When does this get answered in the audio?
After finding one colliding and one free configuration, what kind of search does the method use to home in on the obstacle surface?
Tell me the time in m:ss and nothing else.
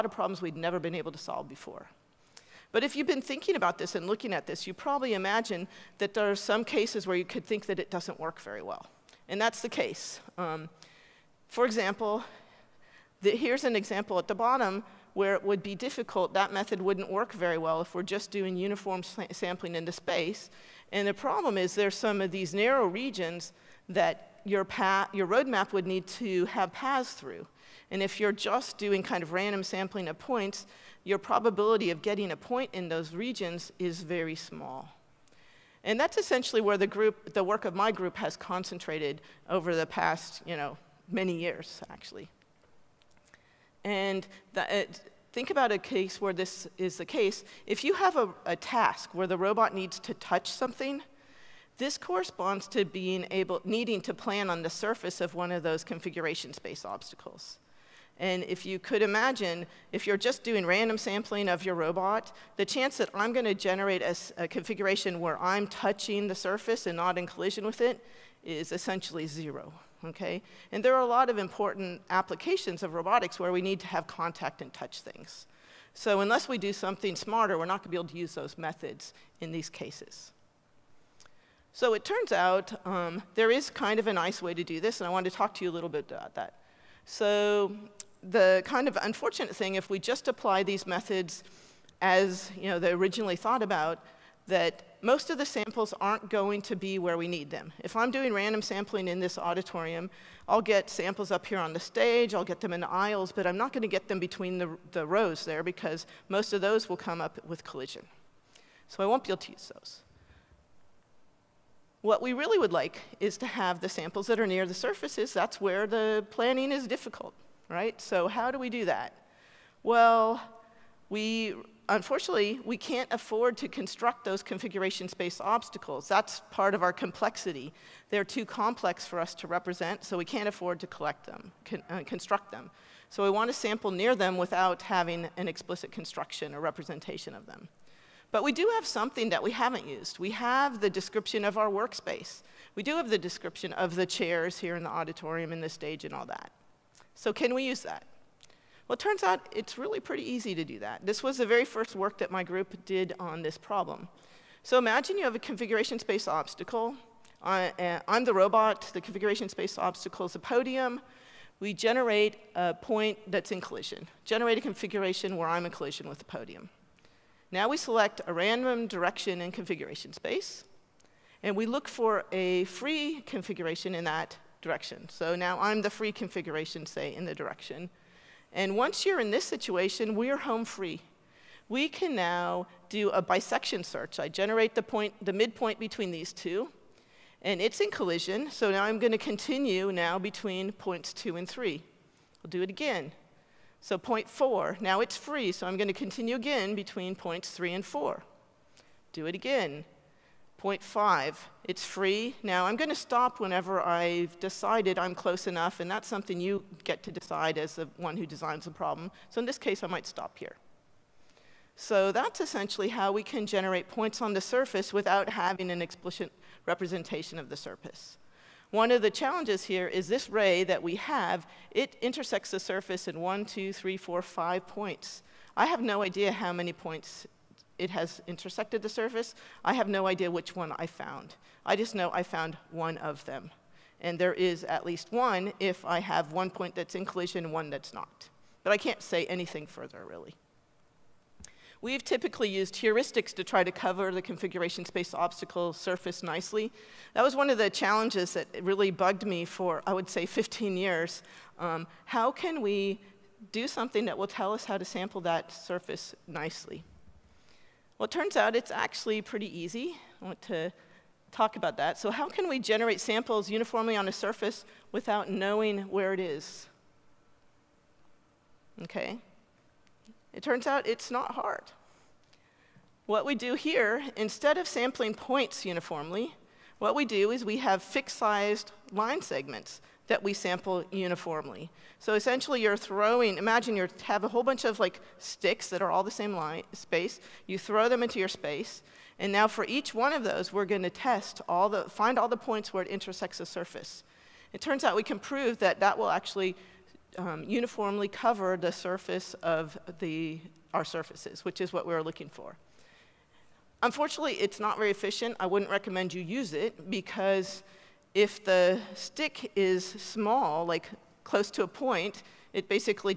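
3:03.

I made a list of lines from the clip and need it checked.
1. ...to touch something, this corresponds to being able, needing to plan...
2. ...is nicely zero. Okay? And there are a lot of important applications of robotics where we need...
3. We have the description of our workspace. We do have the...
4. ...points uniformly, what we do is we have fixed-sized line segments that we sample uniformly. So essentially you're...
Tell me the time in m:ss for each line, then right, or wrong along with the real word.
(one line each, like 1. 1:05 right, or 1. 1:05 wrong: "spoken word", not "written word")
1. 0:50 right
2. 1:08 wrong: "essentially", not "nicely"
3. 2:20 right
4. 4:35 right.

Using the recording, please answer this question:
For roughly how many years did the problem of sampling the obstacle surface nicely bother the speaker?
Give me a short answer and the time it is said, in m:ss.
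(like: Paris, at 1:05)
15 years, at 4:10.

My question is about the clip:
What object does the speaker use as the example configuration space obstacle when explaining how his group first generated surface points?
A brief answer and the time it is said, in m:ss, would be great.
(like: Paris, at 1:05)
A podium, at 2:38.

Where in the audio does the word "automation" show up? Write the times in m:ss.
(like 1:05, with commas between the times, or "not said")
not said.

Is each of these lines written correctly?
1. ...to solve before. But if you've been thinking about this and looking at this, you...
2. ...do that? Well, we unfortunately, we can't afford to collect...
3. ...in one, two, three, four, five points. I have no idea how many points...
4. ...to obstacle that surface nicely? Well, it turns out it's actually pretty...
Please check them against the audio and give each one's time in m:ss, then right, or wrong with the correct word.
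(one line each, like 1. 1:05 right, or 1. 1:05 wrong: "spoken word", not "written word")
1. 0:01 right
2. 1:58 wrong: "construct", not "collect"
3. 3:43 right
4. 4:14 wrong: "sample", not "obstacle".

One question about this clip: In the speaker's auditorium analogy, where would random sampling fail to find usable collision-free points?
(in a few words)
The rows.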